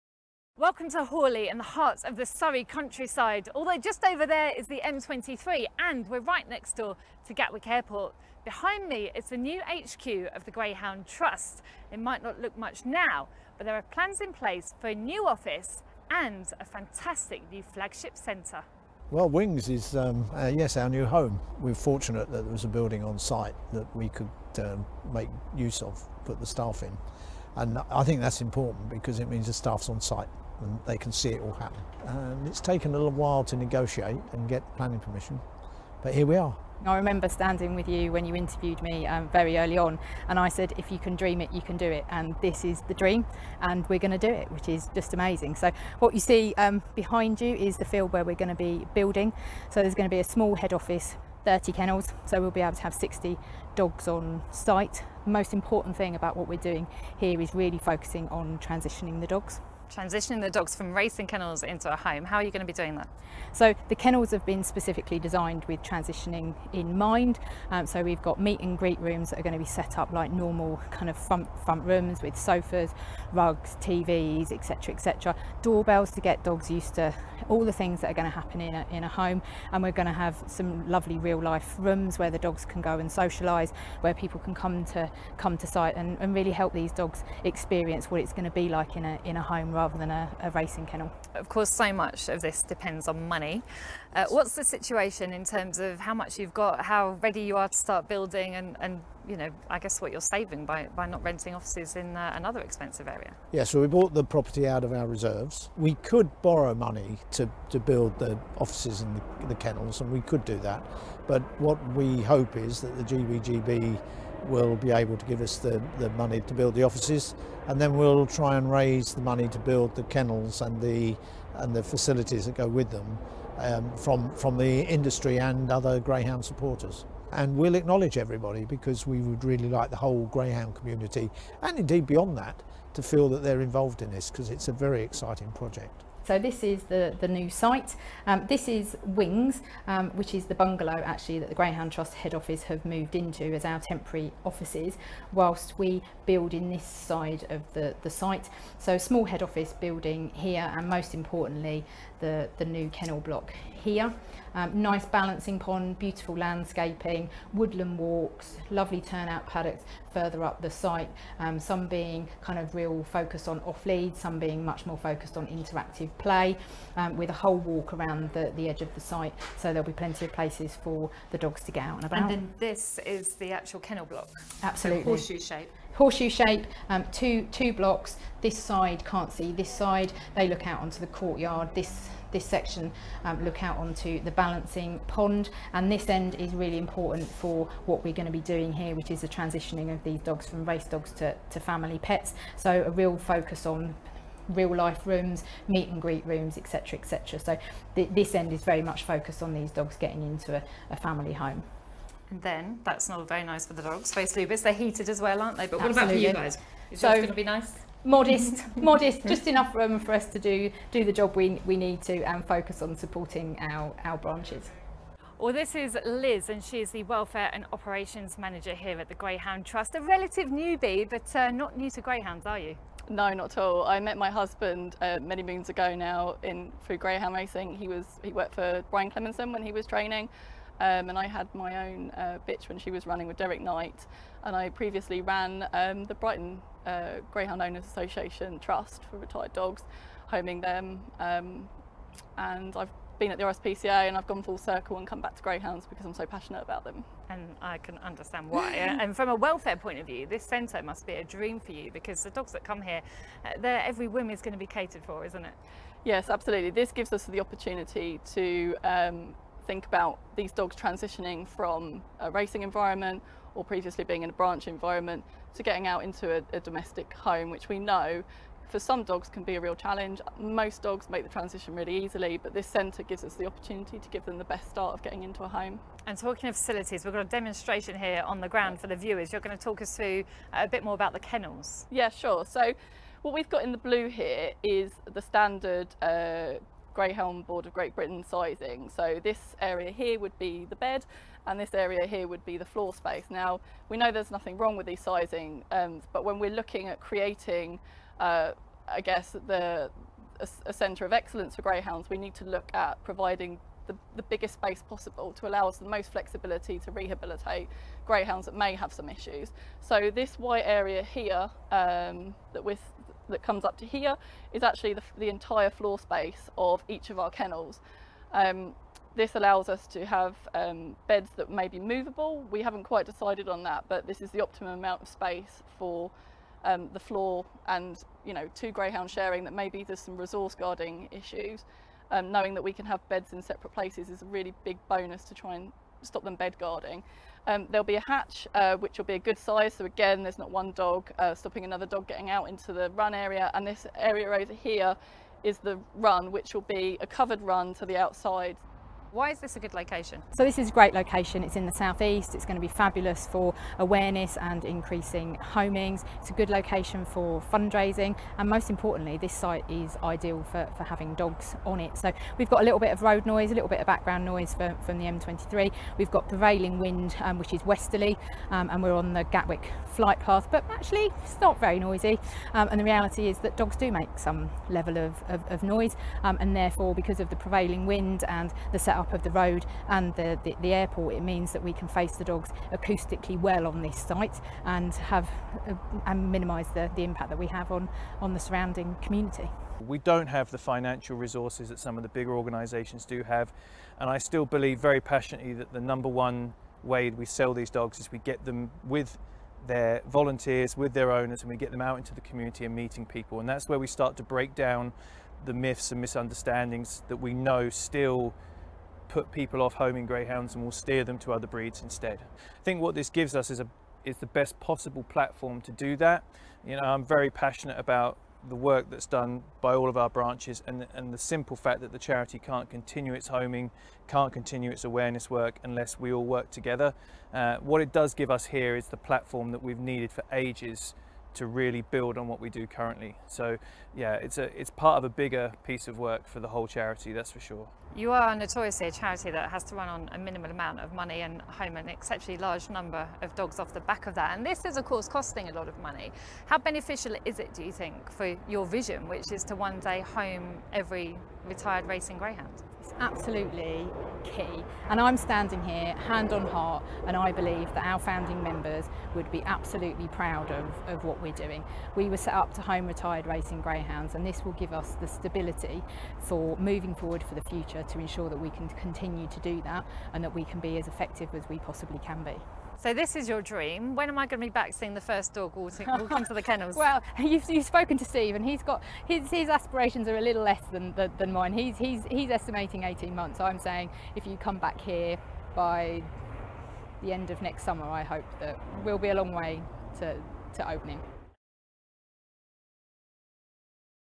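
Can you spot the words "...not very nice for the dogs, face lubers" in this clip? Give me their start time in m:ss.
3:23.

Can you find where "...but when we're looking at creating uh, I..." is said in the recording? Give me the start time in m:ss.
4:56.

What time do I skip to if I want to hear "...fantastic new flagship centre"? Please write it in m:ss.
0:16.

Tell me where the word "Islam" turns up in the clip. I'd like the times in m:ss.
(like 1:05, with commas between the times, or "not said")
not said.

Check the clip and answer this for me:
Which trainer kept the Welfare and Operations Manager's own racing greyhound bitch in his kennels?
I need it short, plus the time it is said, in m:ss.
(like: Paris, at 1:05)
Derek Knight, at 3:53.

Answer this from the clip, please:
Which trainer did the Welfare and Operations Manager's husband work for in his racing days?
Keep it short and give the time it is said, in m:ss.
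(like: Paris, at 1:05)
Brian Clemenson, at 3:48.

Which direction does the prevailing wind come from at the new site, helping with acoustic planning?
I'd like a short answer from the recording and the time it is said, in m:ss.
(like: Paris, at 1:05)
Westerly, at 6:07.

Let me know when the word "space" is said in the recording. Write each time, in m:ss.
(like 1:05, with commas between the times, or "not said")
4:52, 5:04, 5:15, 5:25.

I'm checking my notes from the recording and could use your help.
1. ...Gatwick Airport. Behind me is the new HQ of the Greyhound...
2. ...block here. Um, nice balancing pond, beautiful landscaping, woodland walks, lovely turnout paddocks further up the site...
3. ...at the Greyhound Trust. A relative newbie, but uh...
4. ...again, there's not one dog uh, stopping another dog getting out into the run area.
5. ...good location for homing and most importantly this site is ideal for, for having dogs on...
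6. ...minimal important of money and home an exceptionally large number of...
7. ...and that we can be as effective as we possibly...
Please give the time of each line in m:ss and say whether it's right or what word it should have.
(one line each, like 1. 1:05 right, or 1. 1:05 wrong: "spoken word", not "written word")
1. 0:07 right
2. 2:33 right
3. 3:39 right
4. 5:39 right
5. 5:56 wrong: "fundraising", not "homing"
6. 7:20 wrong: "amount", not "important"
7. 7:50 right.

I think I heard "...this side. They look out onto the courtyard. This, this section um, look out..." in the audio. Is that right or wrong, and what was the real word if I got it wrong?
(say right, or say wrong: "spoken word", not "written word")
right.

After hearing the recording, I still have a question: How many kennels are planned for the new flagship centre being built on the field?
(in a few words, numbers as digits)
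30.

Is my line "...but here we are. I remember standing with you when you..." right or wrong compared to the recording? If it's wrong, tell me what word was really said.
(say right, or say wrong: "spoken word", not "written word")
right.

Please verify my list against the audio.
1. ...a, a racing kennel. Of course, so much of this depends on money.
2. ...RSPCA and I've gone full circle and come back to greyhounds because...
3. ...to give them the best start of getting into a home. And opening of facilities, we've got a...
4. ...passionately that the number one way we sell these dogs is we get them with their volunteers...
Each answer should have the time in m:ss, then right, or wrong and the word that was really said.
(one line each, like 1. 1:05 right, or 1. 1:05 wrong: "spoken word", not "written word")
1. 1:30 right
2. 4:03 right
3. 4:33 wrong: "talking", not "opening"
4. 6:35 right.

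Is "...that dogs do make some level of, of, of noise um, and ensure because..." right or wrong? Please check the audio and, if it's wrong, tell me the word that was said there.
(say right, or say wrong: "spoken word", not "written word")
wrong: "therefore", not "ensure".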